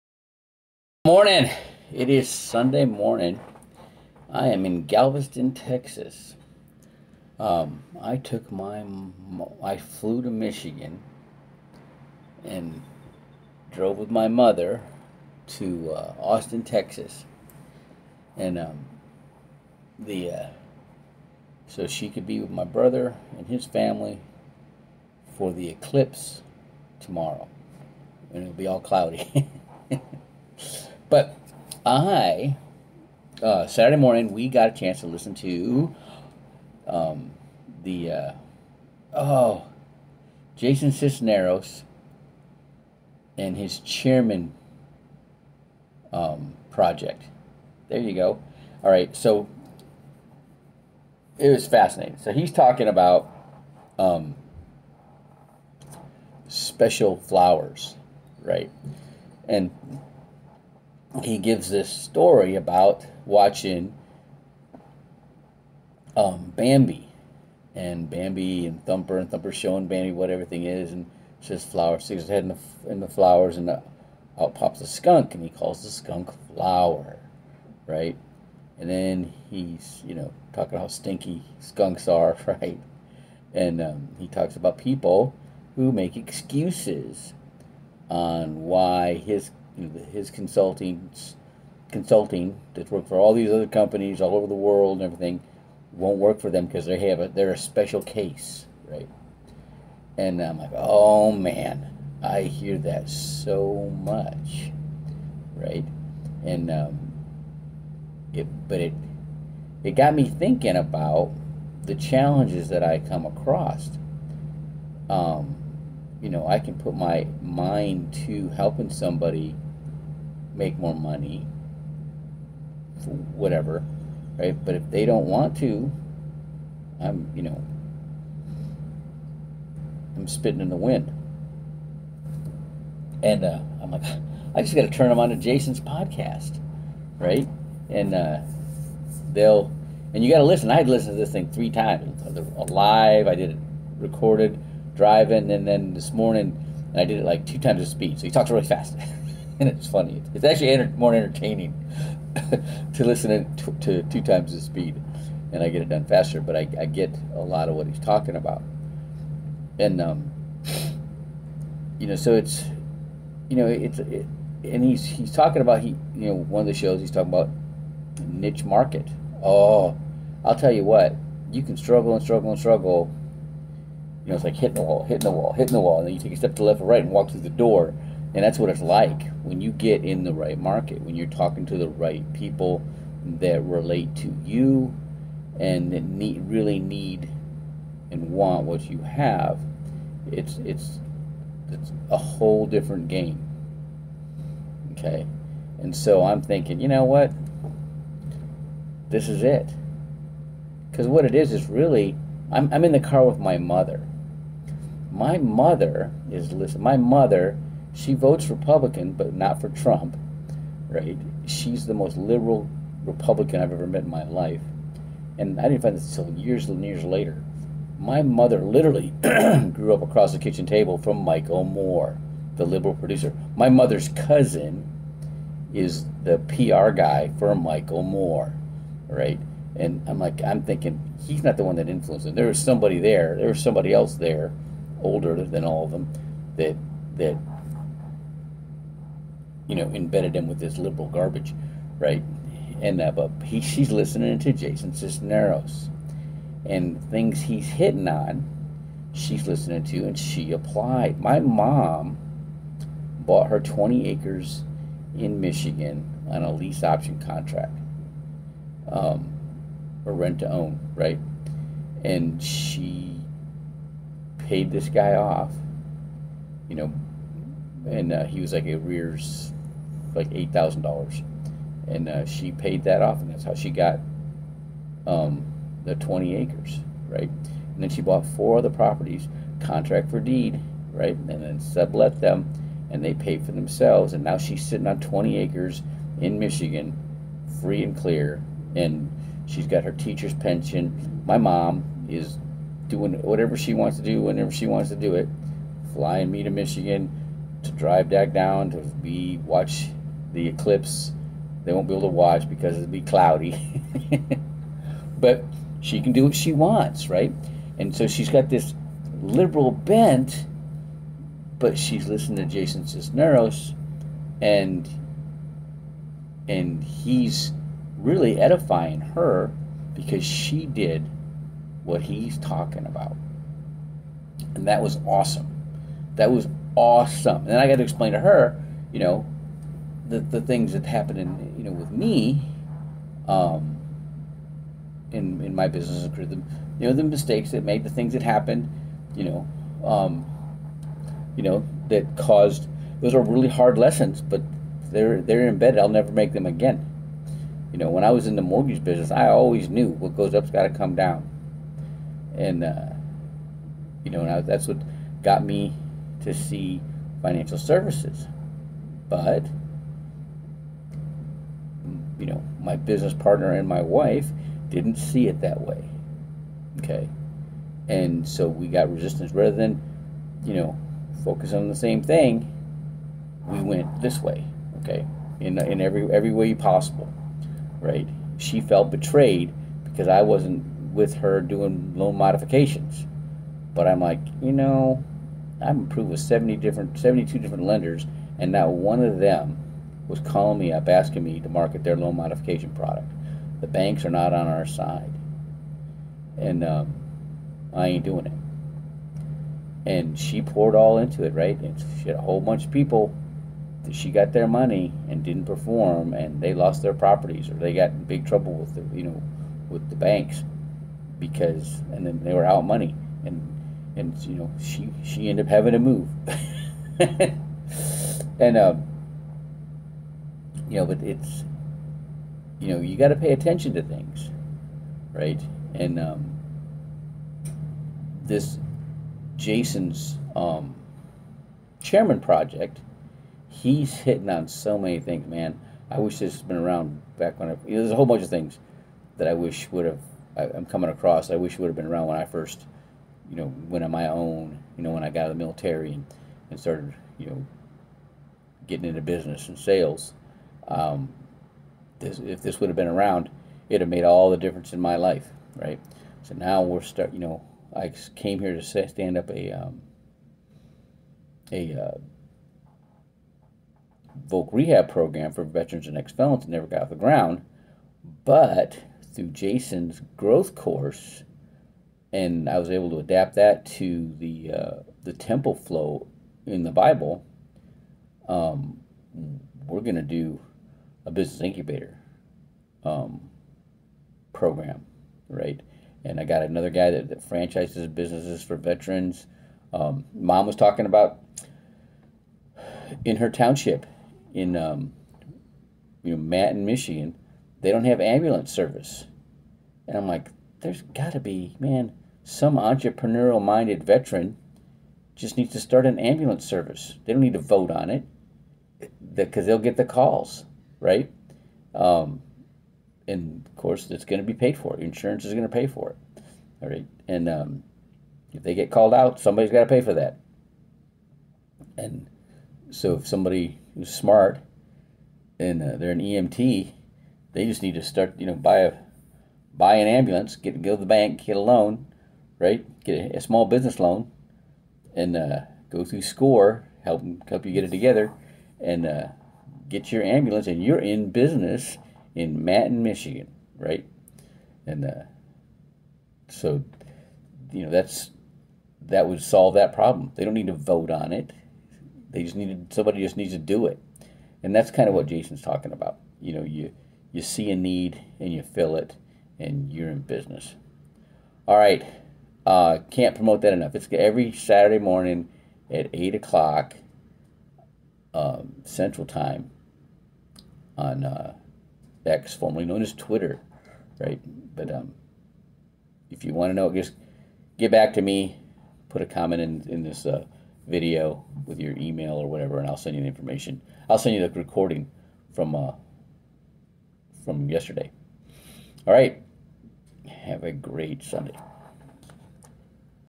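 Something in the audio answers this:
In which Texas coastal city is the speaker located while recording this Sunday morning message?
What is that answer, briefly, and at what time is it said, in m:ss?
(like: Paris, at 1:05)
Galveston, at 0:04.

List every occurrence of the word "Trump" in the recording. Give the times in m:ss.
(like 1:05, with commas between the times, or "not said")
3:29.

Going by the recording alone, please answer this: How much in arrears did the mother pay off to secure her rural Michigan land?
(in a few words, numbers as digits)
$8,000.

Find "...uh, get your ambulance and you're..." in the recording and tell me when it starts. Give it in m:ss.
8:58.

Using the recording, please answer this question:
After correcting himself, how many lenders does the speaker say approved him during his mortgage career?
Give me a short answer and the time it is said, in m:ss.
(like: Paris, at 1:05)
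72, at 6:26.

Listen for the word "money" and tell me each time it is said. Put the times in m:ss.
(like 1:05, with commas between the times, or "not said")
2:00, 6:44, 6:52.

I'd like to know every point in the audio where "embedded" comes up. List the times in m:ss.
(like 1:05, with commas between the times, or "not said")
3:59, 5:45.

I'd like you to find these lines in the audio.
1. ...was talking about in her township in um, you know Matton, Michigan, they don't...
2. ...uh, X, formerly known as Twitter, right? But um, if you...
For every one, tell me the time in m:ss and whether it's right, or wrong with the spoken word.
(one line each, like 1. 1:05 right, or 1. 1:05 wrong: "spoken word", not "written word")
1. 8:10 right
2. 9:31 right.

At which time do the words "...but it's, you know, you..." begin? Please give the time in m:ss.
7:00.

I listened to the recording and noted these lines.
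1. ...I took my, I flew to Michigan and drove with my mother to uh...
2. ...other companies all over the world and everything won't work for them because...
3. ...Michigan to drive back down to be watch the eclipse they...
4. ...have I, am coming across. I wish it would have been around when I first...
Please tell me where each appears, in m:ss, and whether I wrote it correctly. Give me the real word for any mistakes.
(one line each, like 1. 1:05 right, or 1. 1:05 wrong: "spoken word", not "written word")
1. 0:07 right
2. 1:33 right
3. 4:56 right
4. 7:19 right.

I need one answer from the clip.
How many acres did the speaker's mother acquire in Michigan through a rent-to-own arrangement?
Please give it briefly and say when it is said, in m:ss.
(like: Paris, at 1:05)
20, at 4:13.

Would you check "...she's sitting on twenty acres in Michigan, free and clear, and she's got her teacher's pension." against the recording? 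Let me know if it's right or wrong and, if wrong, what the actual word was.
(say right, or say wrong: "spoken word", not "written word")
right.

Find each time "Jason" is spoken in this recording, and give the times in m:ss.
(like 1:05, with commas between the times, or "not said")
0:40, 2:15, 4:04, 5:12, 7:09, 7:49, 9:15.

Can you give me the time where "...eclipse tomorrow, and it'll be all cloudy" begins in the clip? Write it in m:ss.
0:25.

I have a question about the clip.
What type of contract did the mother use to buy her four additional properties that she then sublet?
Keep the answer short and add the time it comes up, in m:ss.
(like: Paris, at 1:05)
Contract for deed, at 4:39.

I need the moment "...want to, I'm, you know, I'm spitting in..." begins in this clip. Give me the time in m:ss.
2:05.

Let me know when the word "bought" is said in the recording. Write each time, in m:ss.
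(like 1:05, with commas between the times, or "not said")
4:13, 4:38.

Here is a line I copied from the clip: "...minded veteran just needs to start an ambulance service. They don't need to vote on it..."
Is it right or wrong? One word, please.
right.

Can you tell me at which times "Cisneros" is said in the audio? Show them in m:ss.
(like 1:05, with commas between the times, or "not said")
0:40, 4:04, 5:12.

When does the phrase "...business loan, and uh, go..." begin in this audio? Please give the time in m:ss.
8:53.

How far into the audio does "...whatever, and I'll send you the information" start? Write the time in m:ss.
9:42.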